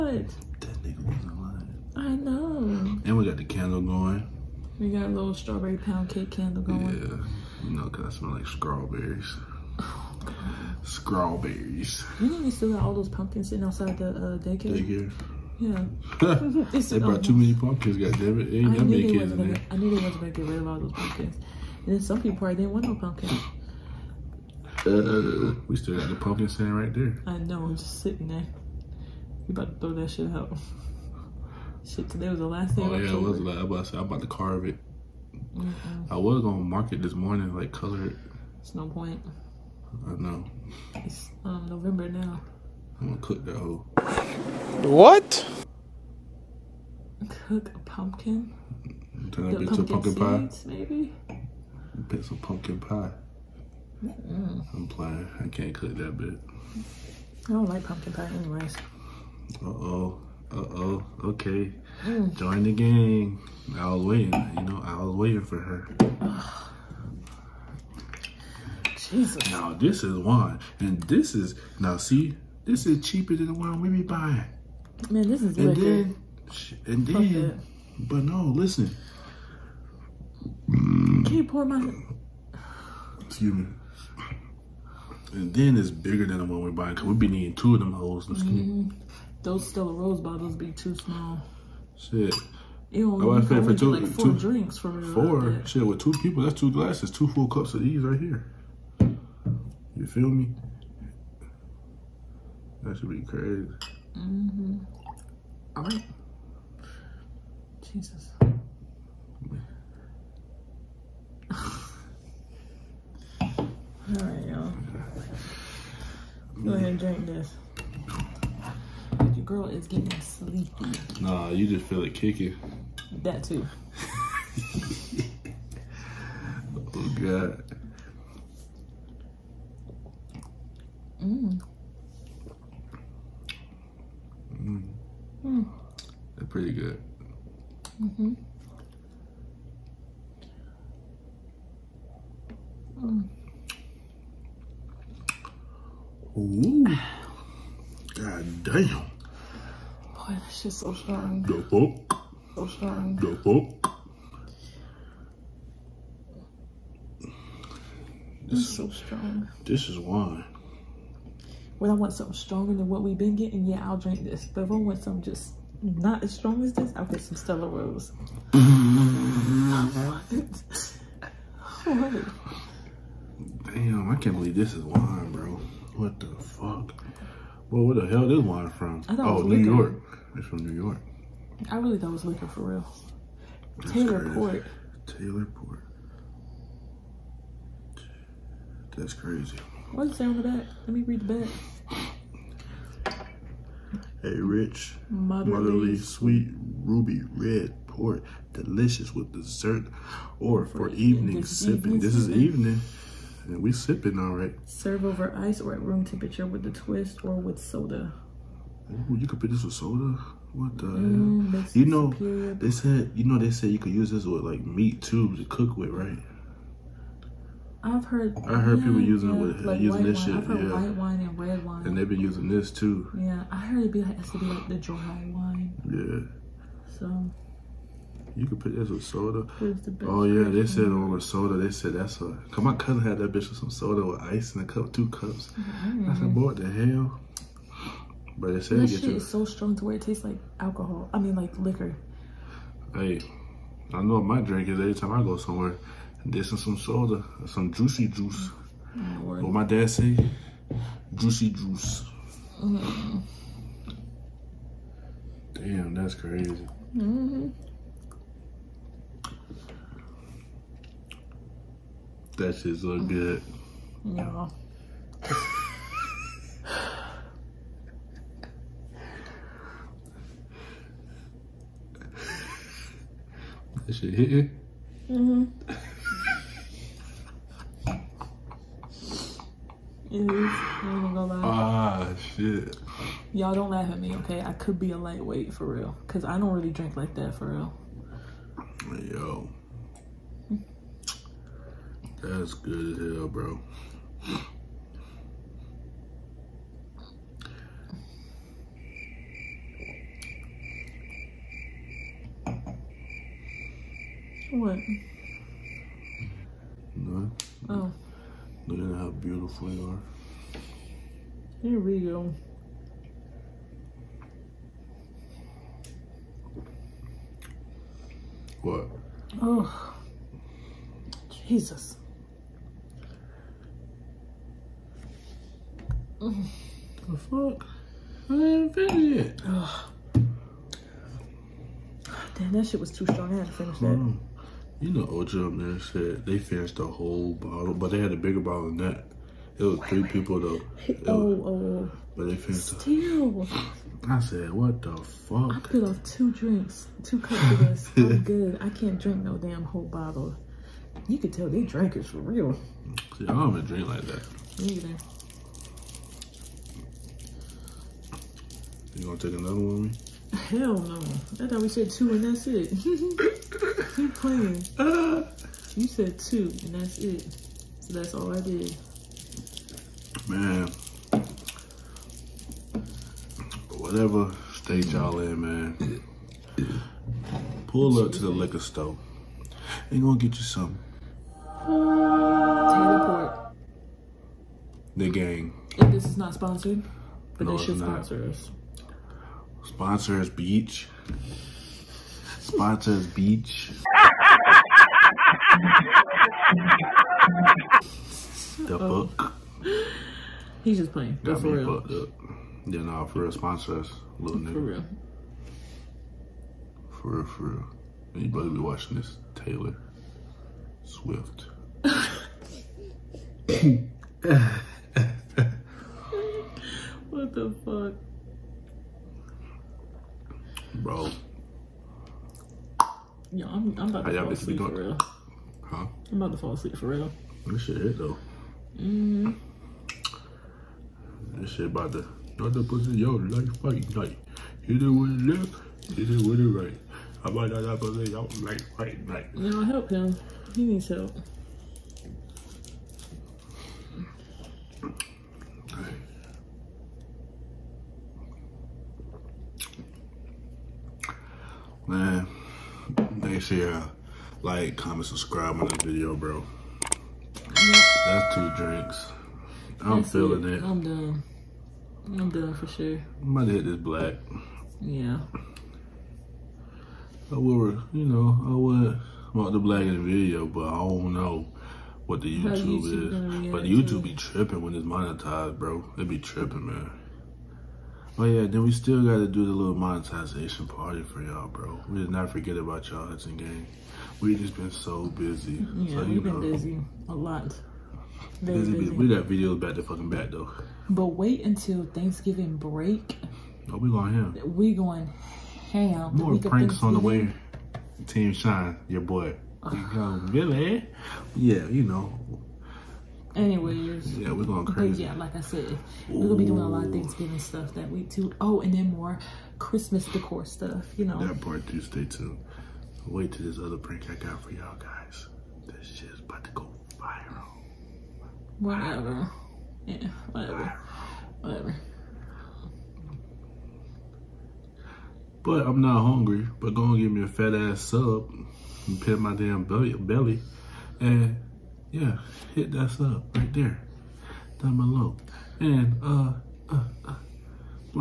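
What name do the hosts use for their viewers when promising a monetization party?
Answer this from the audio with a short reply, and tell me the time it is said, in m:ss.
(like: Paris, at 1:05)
Hudson gang, at 8:03.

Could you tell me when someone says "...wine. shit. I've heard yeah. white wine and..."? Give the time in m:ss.
3:40.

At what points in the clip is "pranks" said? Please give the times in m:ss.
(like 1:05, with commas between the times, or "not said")
8:16, 8:33.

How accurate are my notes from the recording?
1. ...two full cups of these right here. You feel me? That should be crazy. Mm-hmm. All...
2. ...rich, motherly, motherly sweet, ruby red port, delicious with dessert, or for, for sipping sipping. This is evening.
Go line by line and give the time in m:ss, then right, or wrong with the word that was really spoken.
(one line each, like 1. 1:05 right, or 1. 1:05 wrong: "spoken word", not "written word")
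1. 1:37 right
2. 3:14 wrong: "evening", not "sipping".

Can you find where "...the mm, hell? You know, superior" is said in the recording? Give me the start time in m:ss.
3:30.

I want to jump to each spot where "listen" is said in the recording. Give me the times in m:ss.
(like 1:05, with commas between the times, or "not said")
1:18.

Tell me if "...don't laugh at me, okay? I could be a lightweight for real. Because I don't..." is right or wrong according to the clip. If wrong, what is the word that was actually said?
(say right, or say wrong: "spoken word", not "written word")
right.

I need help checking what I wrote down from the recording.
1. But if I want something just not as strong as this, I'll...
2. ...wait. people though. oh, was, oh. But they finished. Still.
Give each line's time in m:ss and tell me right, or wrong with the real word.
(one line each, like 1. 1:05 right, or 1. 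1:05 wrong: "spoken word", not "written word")
1. 2:44 right
2. 5:40 right.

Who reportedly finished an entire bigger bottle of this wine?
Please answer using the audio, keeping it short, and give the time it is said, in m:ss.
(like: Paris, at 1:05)
Ocho Man, at 5:35.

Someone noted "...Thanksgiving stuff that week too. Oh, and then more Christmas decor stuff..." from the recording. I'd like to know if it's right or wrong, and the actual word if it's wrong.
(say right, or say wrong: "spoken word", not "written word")
right.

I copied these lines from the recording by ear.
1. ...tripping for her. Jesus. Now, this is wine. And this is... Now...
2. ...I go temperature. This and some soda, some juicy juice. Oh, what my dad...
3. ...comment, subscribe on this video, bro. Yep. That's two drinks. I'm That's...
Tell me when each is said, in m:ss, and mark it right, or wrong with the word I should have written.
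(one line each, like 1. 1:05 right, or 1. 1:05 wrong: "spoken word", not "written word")
1. 1:05 wrong: "waiting", not "tripping"
2. 4:05 wrong: "somewhere", not "temperature"
3. 7:34 right.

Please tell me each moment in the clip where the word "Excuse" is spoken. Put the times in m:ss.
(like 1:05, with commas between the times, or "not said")
1:23.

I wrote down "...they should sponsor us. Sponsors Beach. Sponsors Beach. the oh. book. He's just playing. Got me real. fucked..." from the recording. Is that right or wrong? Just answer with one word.
right.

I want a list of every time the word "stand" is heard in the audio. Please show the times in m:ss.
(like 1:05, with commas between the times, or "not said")
0:26.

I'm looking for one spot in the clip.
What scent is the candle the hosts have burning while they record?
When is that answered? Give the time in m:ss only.
0:05.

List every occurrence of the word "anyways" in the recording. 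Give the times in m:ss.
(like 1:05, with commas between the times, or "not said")
0:58, 8:23.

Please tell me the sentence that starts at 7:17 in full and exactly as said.
How about that pussy yo like fight night?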